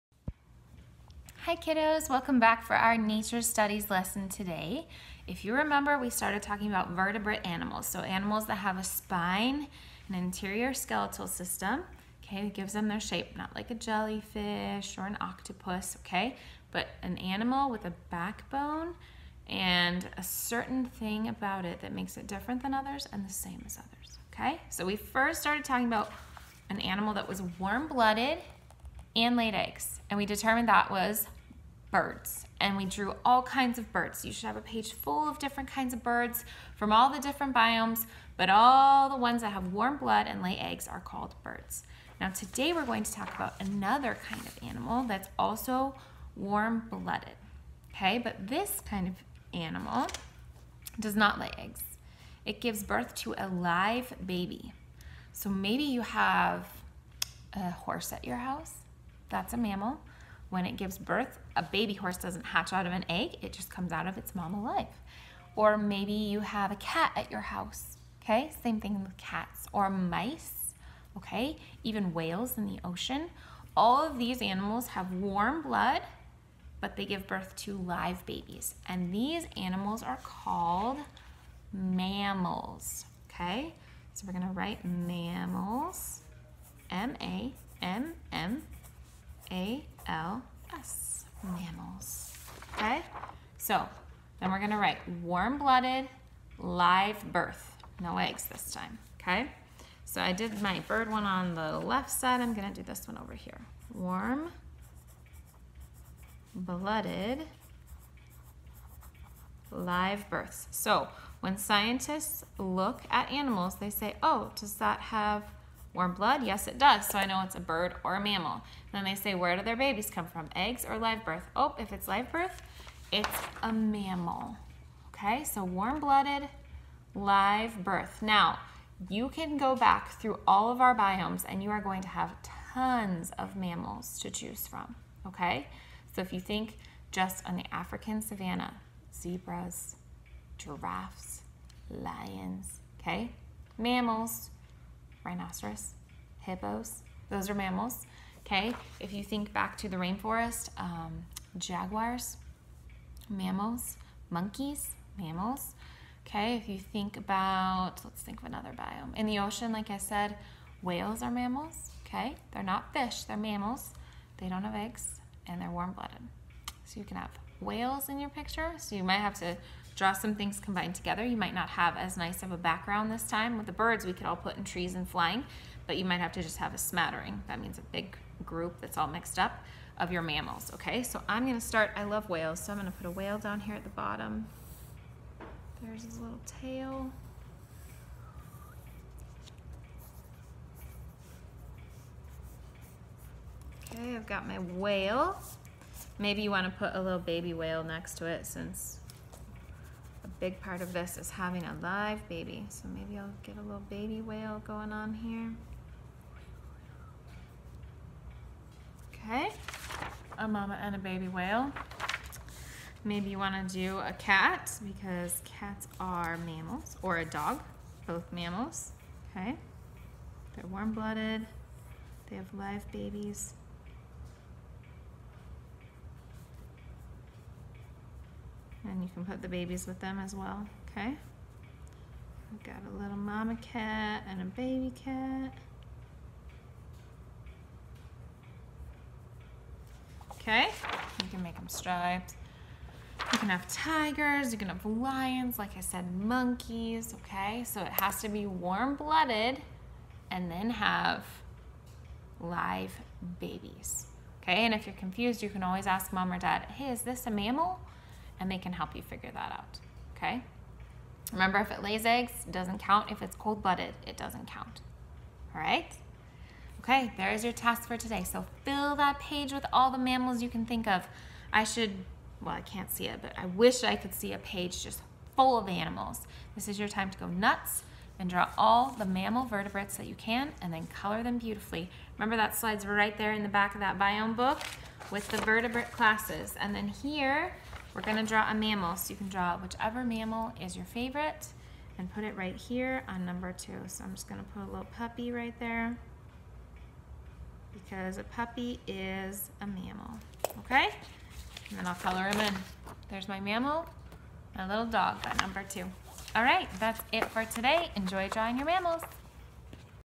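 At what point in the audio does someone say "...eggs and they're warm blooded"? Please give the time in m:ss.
2:44.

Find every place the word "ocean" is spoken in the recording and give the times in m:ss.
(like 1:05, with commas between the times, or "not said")
1:12, 2:39.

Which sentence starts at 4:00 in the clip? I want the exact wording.
Okay, you can make them striped.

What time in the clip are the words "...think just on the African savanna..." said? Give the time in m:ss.
2:16.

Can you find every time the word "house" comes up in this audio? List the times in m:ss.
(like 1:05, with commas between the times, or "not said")
0:58, 1:07.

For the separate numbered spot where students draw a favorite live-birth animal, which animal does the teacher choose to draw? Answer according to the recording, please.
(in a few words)
A puppy.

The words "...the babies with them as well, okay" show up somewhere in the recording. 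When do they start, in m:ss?
3:49.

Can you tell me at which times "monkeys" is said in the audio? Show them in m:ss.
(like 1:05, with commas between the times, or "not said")
2:34, 4:06.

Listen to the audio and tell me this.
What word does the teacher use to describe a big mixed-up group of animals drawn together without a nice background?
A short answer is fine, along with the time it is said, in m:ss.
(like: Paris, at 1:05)
Smattering, at 2:56.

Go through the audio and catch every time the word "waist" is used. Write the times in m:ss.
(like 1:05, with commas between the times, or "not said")
not said.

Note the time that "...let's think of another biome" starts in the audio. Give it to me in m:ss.
2:38.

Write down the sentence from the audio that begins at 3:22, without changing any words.
So maybe I'll get a little baby whale going on here.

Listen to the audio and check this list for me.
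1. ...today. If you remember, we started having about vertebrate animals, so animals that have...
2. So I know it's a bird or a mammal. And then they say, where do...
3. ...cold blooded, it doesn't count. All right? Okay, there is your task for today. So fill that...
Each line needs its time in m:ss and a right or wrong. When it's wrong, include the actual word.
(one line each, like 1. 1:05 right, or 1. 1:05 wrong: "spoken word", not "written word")
1. 0:04 wrong: "talking", not "having"
2. 1:57 right
3. 4:23 right.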